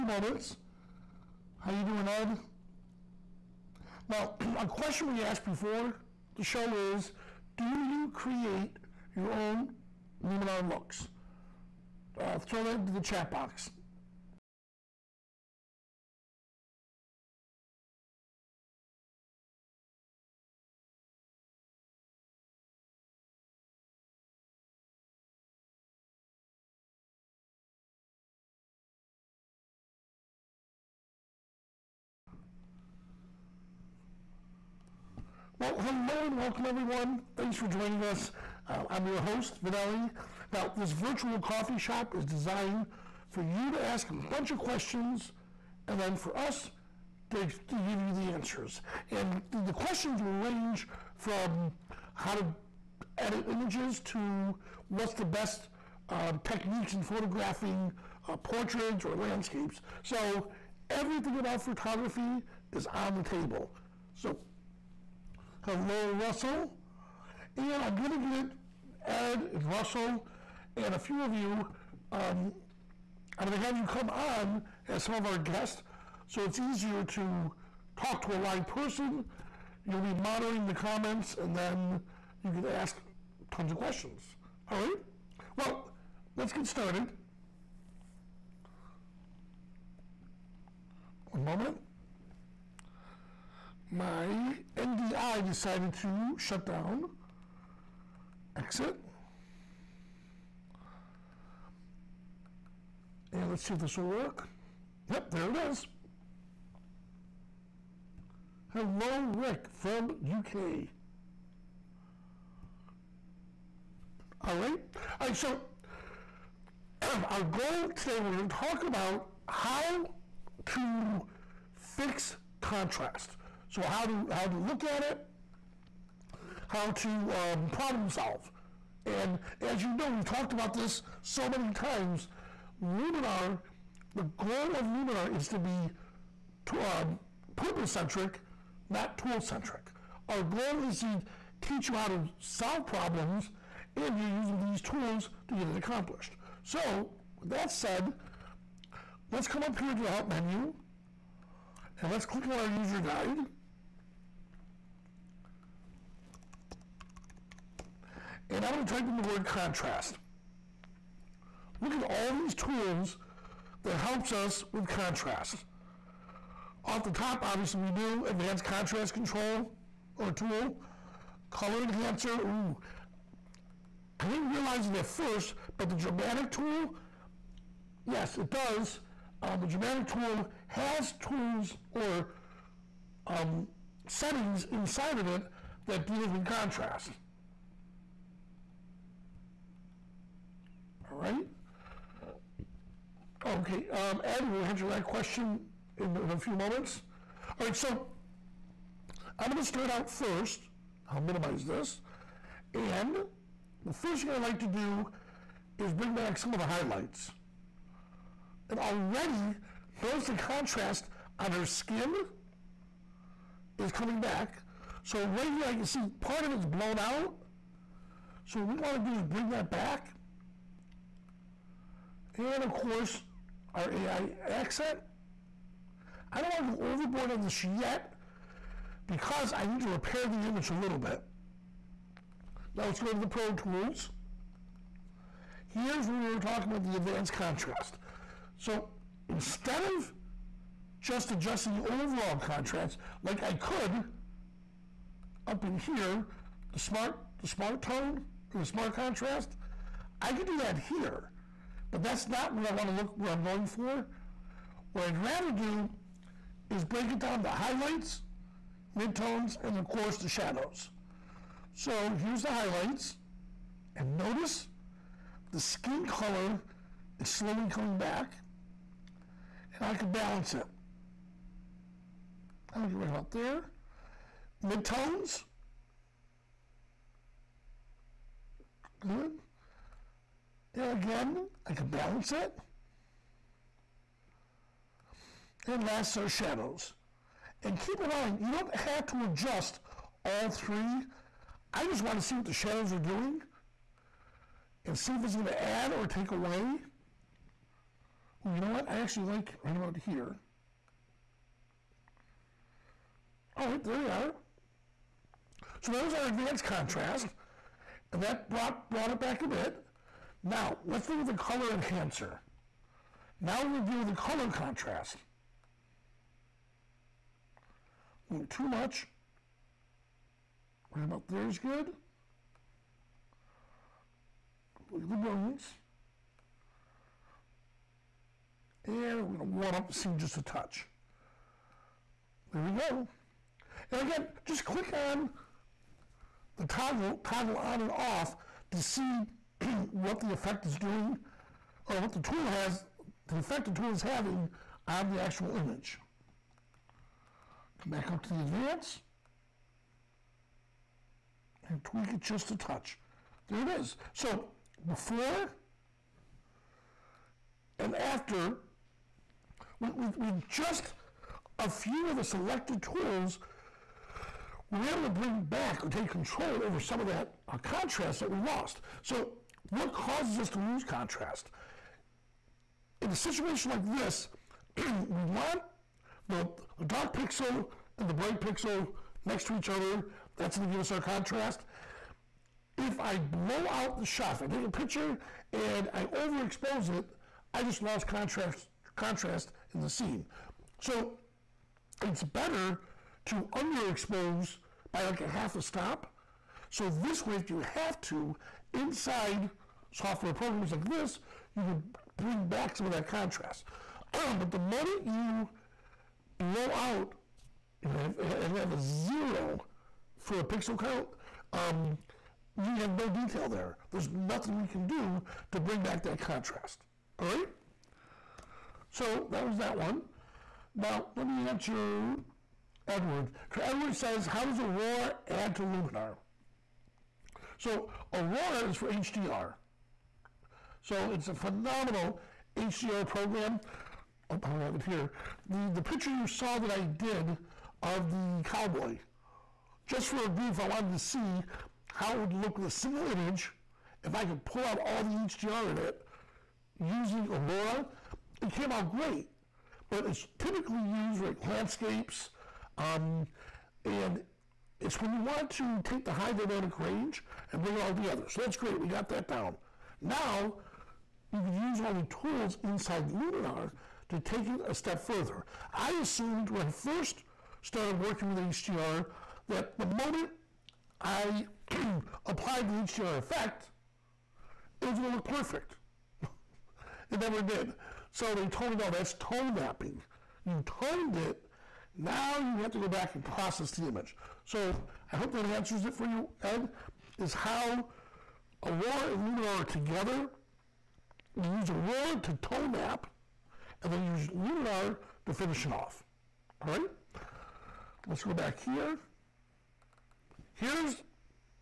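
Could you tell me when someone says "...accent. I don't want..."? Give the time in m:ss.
3:44.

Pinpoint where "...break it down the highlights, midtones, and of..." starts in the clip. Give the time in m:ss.
4:16.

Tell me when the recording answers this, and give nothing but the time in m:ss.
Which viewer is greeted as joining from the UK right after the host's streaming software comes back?
1:49.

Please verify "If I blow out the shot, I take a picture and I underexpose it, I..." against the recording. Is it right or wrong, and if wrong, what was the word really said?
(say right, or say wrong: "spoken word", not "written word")
wrong: "overexpose", not "underexpose".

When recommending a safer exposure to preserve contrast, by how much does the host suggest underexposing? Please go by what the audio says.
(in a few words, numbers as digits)
half a stop.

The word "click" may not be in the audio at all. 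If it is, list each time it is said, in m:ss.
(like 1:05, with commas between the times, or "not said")
2:32, 5:34.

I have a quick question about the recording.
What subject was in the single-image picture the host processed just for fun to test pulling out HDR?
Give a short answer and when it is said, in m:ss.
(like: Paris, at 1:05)
cowboy, at 7:18.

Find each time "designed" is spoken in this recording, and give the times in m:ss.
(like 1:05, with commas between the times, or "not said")
0:42.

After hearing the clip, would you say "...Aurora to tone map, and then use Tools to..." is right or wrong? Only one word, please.
wrong.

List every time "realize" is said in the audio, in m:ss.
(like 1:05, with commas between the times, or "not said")
2:54.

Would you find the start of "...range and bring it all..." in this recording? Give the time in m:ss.
7:36.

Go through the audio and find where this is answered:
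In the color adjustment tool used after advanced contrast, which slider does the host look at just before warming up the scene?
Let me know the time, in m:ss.
5:25.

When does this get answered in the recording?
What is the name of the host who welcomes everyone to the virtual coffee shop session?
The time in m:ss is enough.
0:39.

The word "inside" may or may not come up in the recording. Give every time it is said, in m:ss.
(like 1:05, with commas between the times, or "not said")
3:04, 6:38, 7:42.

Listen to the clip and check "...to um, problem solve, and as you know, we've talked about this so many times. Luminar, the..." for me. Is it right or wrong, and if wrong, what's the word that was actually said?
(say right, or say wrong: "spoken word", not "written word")
right.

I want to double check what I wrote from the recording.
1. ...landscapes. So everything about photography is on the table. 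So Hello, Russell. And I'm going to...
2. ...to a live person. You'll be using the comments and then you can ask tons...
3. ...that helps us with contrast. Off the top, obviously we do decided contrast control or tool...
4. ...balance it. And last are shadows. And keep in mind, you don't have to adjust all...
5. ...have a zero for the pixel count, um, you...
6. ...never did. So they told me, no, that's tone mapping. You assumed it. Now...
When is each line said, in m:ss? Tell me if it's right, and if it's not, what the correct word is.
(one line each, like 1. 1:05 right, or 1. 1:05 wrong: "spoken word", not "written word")
1. 0:59 right
2. 1:18 wrong: "monitoring", not "using"
3. 2:43 wrong: "advanced", not "decided"
4. 4:41 right
5. 6:48 right
6. 7:57 wrong: "toned", not "assumed".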